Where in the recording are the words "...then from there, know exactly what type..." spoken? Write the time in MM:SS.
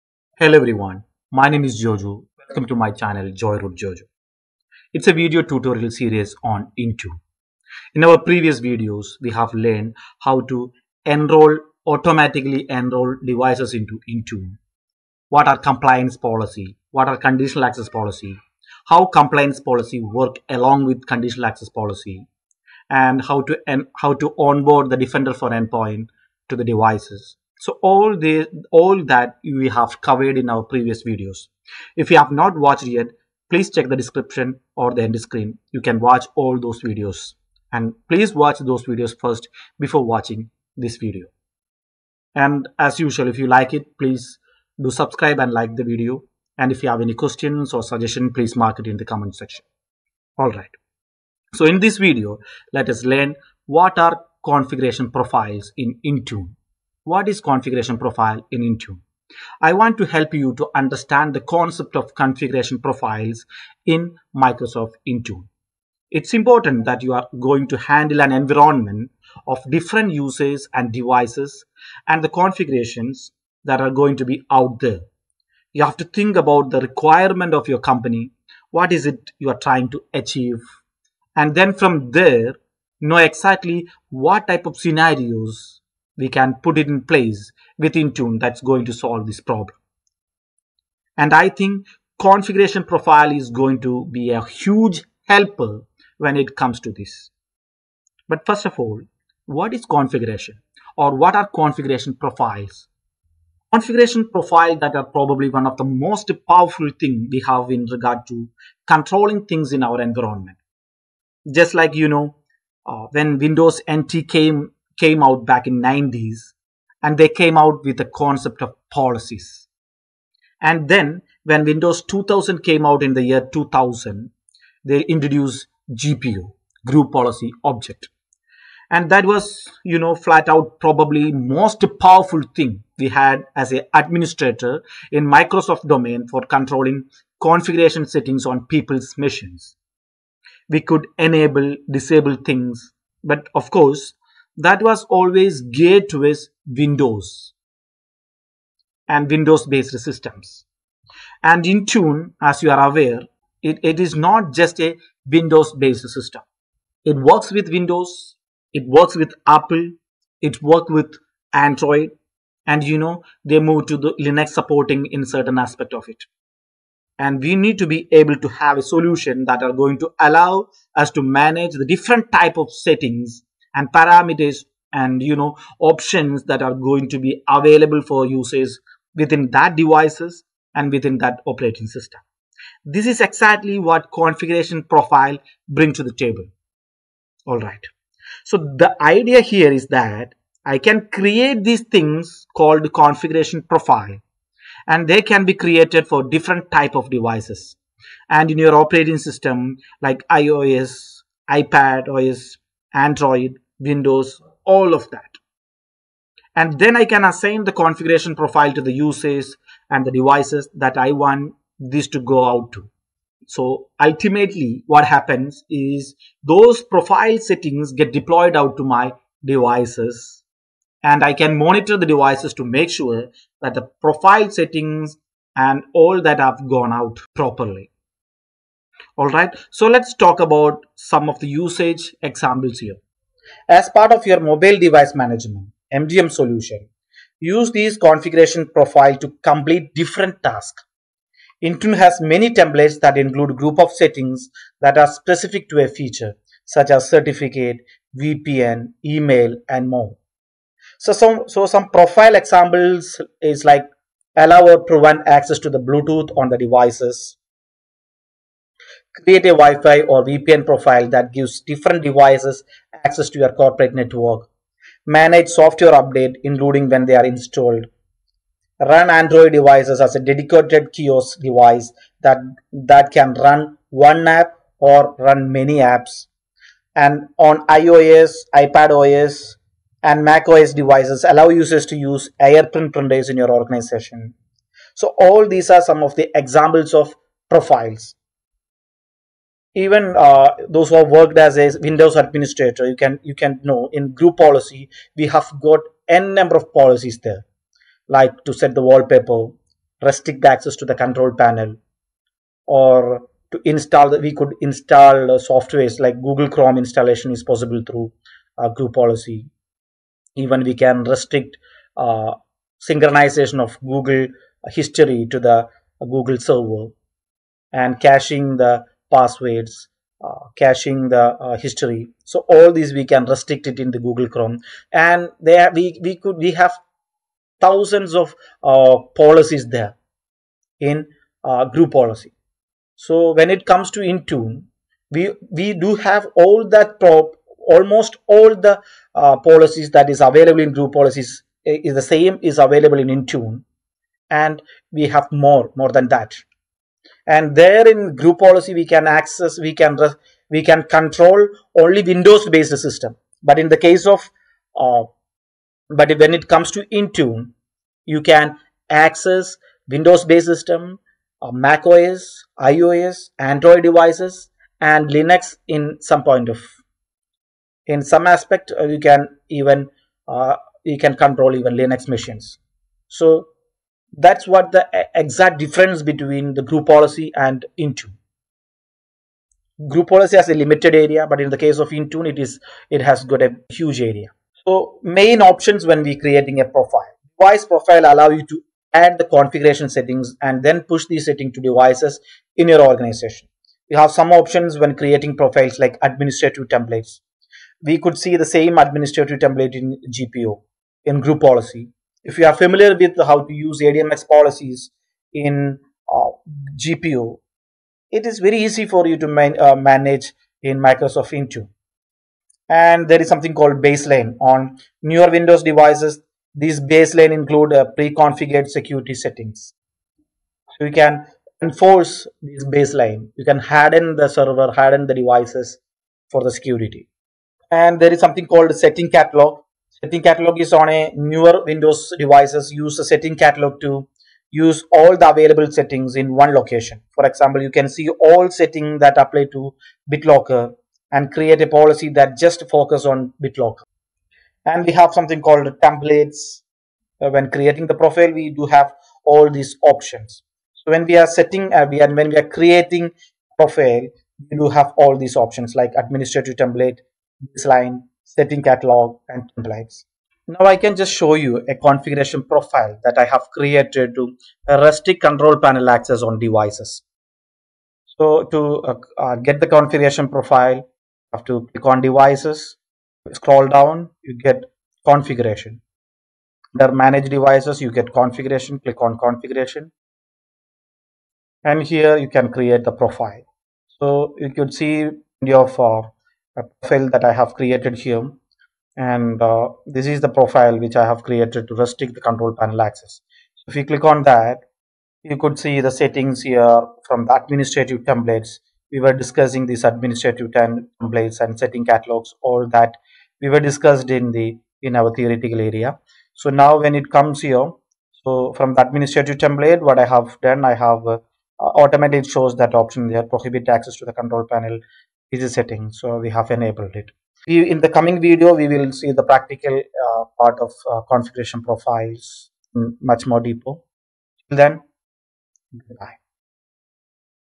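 01:21.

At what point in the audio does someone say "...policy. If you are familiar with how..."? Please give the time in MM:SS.
06:41.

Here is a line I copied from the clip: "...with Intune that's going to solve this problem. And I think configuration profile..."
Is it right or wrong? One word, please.
right.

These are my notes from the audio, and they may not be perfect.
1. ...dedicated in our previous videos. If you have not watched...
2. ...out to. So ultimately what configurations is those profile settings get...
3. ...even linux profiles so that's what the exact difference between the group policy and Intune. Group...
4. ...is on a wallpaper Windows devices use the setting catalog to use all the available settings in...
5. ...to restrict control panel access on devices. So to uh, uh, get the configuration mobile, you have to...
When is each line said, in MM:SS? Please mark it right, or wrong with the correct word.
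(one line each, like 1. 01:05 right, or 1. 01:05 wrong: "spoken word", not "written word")
1. 00:30 wrong: "covered", not "dedicated"
2. 03:32 wrong: "happens", not "configurations"
3. 06:11 wrong: "machines", not "profiles"
4. 07:10 wrong: "newer", not "wallpaper"
5. 07:44 wrong: "profile", not "mobile".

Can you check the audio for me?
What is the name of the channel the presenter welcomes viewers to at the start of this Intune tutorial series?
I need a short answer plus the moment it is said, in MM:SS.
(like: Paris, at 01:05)
Joyroute Jojo, at 00:03.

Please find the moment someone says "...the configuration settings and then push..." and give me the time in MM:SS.
06:29.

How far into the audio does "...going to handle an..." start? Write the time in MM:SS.
01:07.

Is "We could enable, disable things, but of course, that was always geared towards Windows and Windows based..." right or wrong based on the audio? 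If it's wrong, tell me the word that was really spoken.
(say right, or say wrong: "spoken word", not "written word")
right.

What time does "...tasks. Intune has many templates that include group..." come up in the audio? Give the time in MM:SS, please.
04:00.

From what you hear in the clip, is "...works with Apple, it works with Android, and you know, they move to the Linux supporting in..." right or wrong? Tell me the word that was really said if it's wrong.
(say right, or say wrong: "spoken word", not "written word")
right.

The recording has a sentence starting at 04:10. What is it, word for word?
So some, so some profile examples is like allow or prevent access to the Bluetooth on the devices.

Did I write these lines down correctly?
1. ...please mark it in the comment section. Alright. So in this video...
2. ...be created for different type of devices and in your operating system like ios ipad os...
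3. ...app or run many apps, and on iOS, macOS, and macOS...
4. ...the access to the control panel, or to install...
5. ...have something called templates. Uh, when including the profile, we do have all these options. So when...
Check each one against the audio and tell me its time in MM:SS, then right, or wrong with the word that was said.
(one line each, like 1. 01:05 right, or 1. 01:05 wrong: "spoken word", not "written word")
1. 00:48 right
2. 03:15 right
3. 04:34 wrong: "iPadOS", not "macOS"
4. 05:00 right
5. 07:24 wrong: "creating", not "including".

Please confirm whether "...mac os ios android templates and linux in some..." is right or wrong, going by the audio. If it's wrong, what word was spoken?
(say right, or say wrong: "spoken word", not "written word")
wrong: "devices", not "templates".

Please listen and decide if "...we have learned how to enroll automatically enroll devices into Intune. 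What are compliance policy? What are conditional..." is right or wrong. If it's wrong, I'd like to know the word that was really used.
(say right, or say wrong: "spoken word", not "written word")
right.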